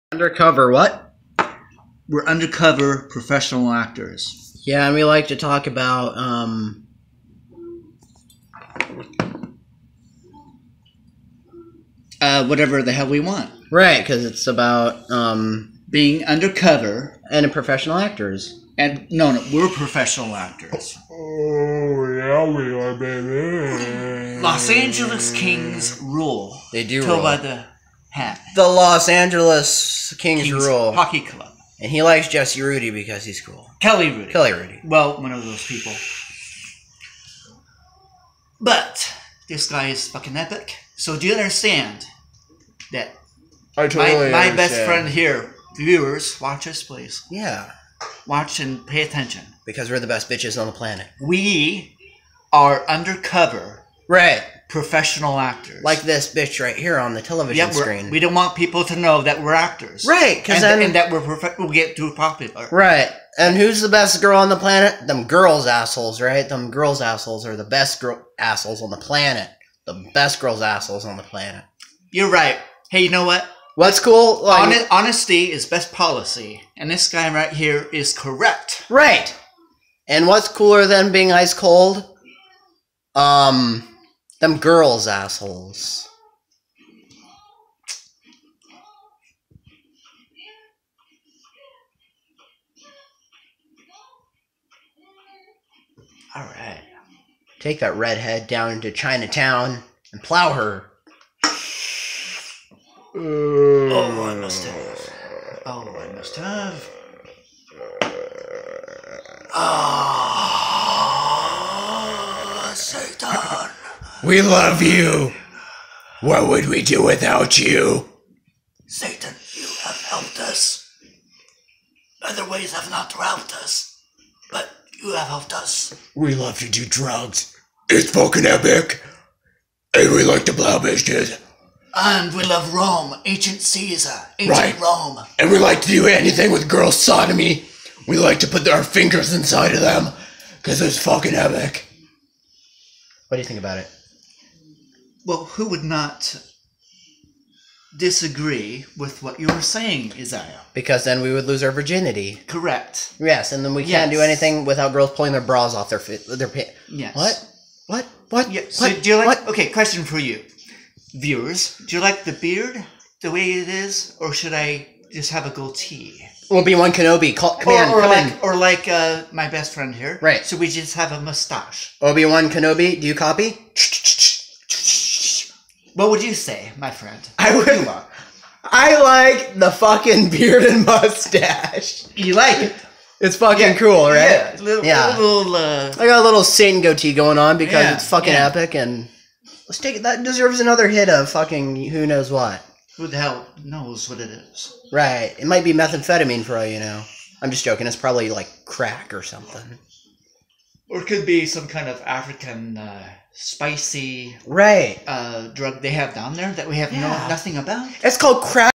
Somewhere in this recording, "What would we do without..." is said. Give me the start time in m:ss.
1:56.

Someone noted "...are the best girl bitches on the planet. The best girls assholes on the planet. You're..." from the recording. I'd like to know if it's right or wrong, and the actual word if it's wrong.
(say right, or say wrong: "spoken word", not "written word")
wrong: "assholes", not "bitches".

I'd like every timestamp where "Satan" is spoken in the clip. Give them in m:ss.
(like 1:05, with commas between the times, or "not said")
1:58, 3:06.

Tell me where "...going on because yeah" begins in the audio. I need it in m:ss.
3:07.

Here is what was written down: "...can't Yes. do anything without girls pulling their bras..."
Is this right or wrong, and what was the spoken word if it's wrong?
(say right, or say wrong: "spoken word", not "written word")
right.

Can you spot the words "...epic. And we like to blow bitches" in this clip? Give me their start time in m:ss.
2:08.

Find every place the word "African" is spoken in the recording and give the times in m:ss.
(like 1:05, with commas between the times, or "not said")
3:22.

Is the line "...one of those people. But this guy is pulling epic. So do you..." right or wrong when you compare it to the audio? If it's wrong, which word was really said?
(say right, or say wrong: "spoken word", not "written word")
wrong: "fucking", not "pulling".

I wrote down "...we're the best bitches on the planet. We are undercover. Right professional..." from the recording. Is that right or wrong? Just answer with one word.
right.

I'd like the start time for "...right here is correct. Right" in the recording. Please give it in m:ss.
1:17.